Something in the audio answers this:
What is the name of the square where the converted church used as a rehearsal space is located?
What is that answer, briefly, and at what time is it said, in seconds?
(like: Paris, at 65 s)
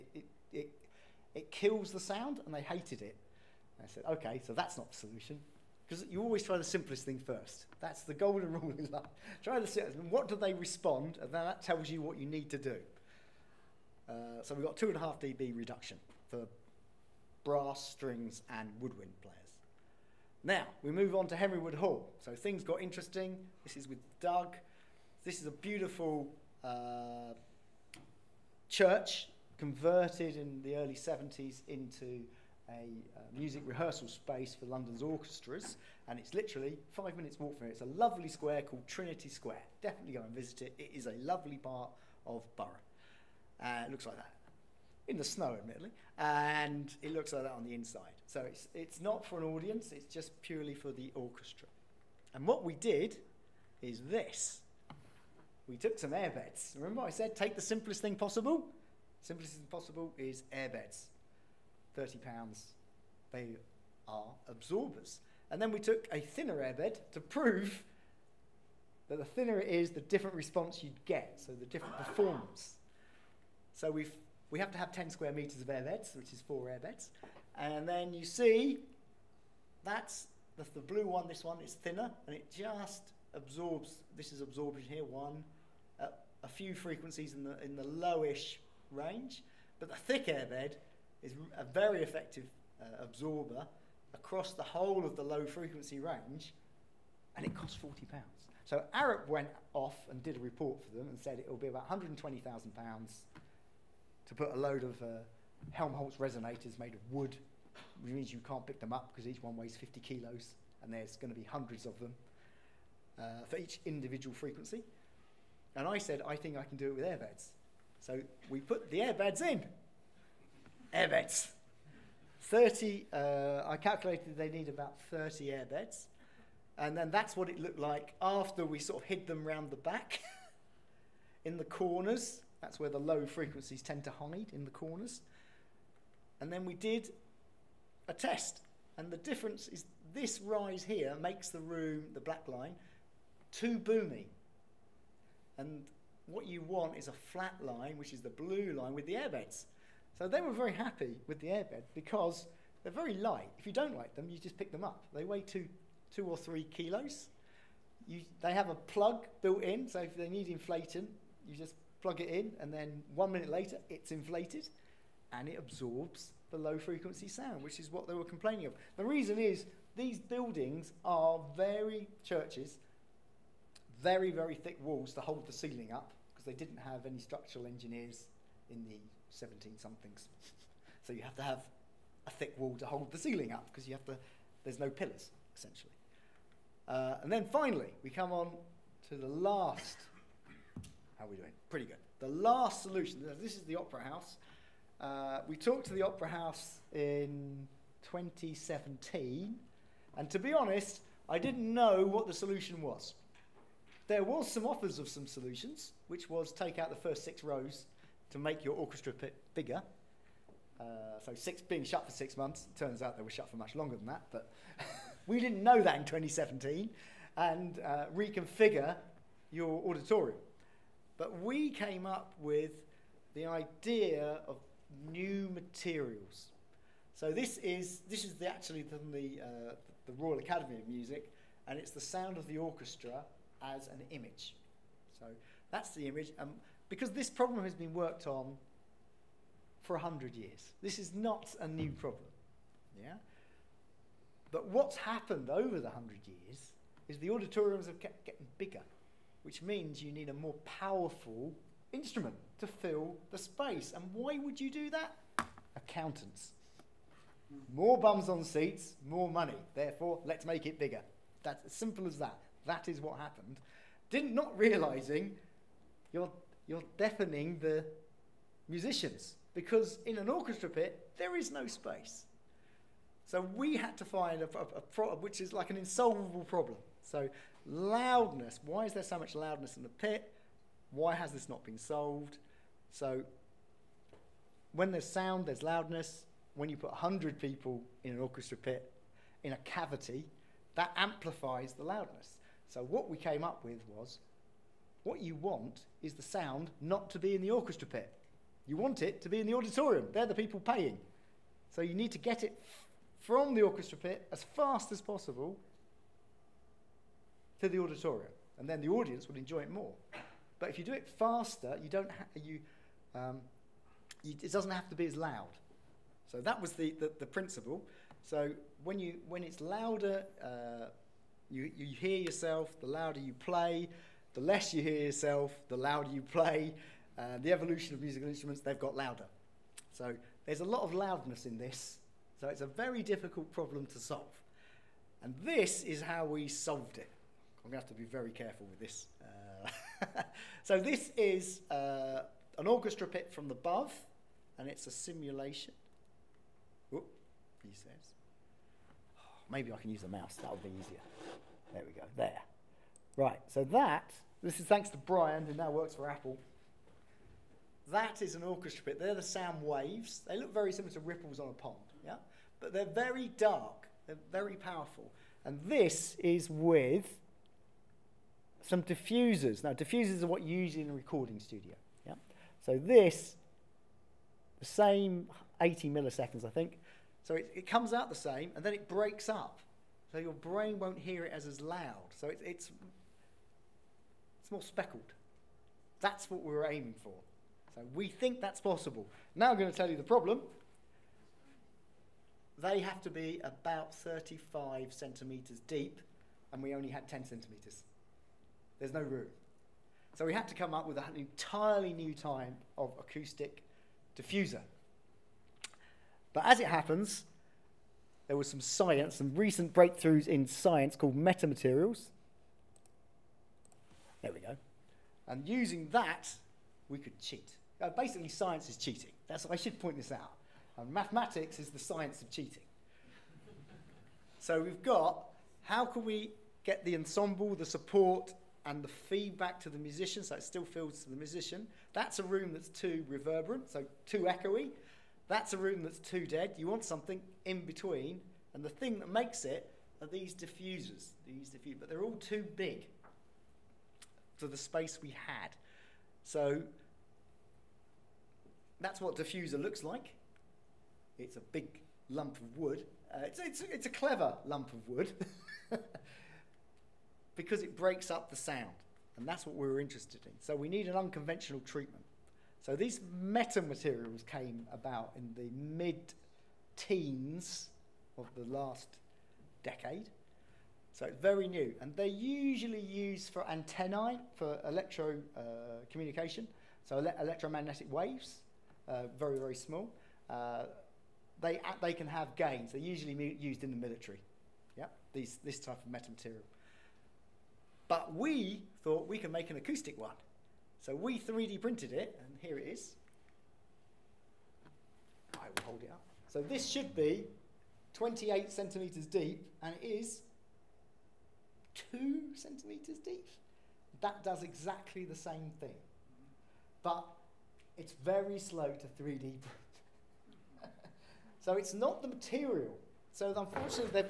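Trinity Square, at 38 s.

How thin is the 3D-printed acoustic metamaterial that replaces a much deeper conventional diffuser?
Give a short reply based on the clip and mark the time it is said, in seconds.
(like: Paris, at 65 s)
2 centimetres, at 501 s.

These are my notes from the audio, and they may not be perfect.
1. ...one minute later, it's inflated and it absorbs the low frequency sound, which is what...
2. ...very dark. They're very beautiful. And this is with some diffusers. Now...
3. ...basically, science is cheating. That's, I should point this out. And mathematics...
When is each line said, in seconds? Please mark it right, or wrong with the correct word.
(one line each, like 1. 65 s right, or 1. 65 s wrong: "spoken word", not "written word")
1. 163 s right
2. 362 s wrong: "powerful", not "beautiful"
3. 417 s right.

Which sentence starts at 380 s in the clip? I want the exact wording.
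So your brain won't hear it as, as loud.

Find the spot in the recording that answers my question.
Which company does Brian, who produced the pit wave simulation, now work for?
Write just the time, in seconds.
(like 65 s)
356 s.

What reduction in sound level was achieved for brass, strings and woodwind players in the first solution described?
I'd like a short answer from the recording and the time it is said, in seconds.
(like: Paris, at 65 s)
2.5 dB, at 14 s.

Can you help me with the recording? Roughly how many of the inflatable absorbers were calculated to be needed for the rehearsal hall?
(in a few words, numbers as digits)
30.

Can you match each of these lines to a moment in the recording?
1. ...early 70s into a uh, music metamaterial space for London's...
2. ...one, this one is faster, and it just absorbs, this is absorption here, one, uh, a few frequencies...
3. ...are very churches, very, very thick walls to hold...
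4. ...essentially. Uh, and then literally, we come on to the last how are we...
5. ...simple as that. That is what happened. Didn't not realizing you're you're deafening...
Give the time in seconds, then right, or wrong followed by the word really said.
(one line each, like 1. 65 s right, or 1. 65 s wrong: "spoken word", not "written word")
1. 30 s wrong: "rehearsal", not "metamaterial"
2. 81 s wrong: "thinner", not "faster"
3. 171 s right
4. 185 s wrong: "finally", not "literally"
5. 261 s right.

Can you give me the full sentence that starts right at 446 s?
So that's what diffuser looks like.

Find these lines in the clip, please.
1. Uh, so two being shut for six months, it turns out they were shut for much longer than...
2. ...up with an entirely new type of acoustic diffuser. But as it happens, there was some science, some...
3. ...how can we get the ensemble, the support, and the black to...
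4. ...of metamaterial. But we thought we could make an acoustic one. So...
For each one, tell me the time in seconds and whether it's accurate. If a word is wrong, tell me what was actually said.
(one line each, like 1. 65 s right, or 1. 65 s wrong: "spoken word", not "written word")
1. 210 s wrong: "six", not "two"
2. 400 s right
3. 425 s wrong: "feedback", not "black"
4. 485 s right.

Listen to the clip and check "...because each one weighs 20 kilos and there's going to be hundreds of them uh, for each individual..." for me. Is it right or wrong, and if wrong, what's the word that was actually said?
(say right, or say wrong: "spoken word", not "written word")
wrong: "50", not "20".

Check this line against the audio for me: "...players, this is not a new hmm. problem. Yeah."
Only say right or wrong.
wrong.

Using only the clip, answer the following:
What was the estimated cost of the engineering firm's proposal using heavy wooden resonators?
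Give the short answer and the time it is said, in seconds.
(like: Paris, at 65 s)
£120,000, at 101 s.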